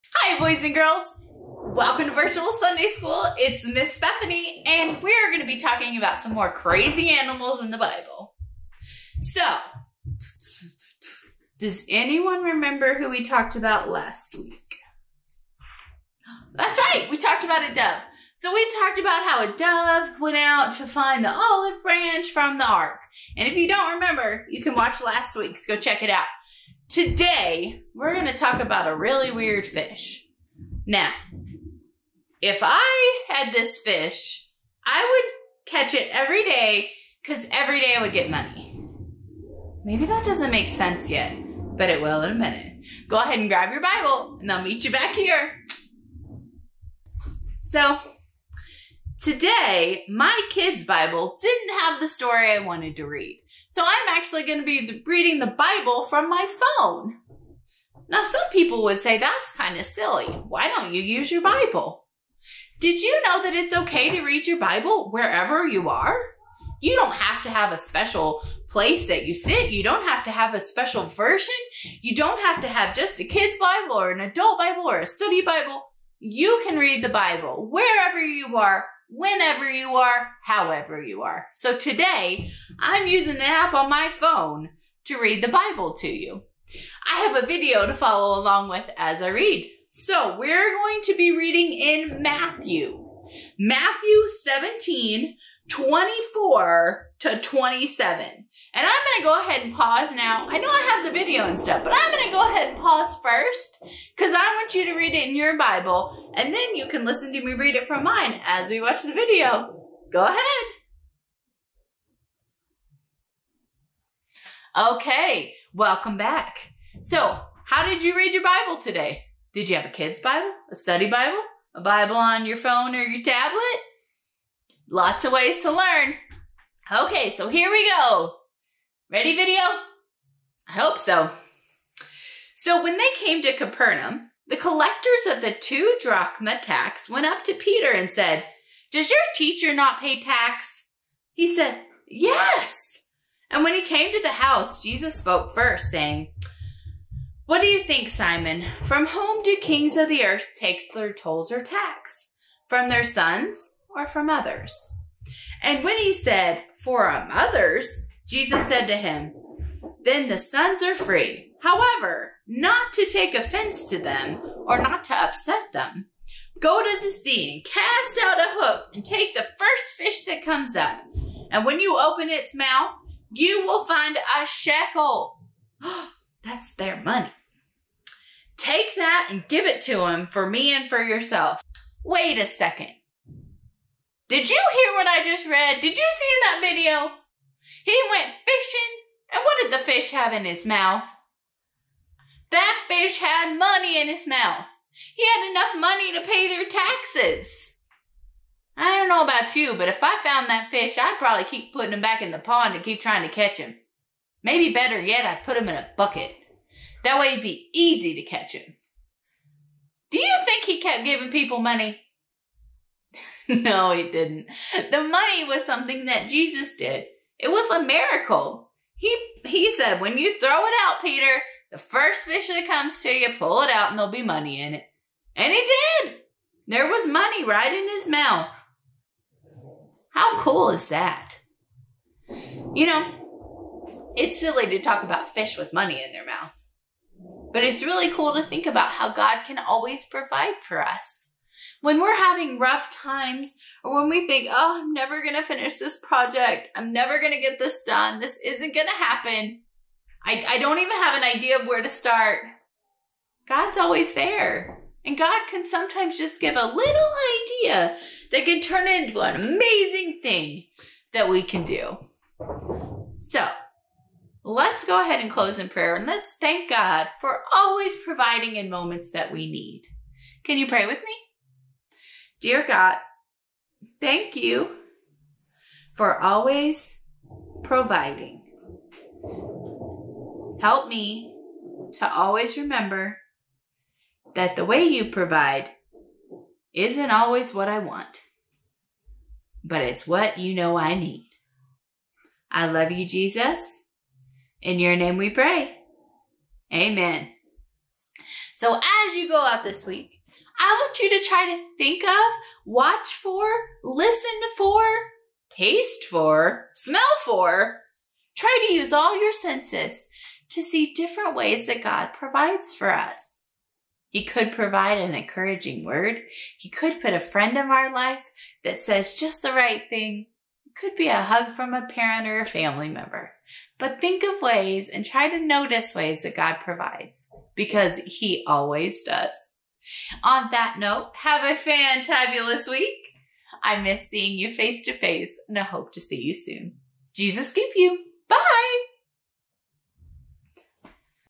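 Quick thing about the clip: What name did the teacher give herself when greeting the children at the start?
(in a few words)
Miss Stephanie.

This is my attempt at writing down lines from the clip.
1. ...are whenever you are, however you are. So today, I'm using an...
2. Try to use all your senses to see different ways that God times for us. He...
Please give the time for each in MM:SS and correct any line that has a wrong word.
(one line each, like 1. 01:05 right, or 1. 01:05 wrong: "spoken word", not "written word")
1. 01:18 right
2. 05:08 wrong: "provides", not "times".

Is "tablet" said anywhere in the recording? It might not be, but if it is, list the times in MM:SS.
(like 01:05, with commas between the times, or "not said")
02:03.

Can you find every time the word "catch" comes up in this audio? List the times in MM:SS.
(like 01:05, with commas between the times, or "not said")
00:35, 03:23, 03:28.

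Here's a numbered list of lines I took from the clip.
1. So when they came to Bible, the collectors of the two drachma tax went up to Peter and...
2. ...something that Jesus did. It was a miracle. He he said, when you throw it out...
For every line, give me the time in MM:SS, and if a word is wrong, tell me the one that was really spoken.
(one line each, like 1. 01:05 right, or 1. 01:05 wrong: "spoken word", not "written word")
1. 02:12 wrong: "Capernaum", not "Bible"
2. 03:35 right.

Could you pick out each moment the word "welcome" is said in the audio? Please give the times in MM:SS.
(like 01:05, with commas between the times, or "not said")
00:01, 01:55.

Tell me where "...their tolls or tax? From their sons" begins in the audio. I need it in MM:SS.
02:30.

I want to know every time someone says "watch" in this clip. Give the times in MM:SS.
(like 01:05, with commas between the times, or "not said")
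00:24, 01:48, 05:02.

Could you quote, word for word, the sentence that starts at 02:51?
And when you open its mouth, you will find a shekel.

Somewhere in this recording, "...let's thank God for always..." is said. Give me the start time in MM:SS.
04:26.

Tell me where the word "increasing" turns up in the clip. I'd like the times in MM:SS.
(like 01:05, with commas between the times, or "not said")
not said.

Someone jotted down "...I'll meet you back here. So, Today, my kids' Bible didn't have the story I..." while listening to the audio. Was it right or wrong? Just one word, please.
right.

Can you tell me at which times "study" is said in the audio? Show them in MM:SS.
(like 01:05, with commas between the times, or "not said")
01:15, 02:00.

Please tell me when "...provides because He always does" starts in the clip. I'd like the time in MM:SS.
05:26.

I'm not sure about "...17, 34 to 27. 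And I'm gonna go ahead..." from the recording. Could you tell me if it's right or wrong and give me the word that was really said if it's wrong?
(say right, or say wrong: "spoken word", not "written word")
wrong: "24", not "34".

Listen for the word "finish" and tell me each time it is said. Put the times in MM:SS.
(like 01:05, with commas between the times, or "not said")
04:05.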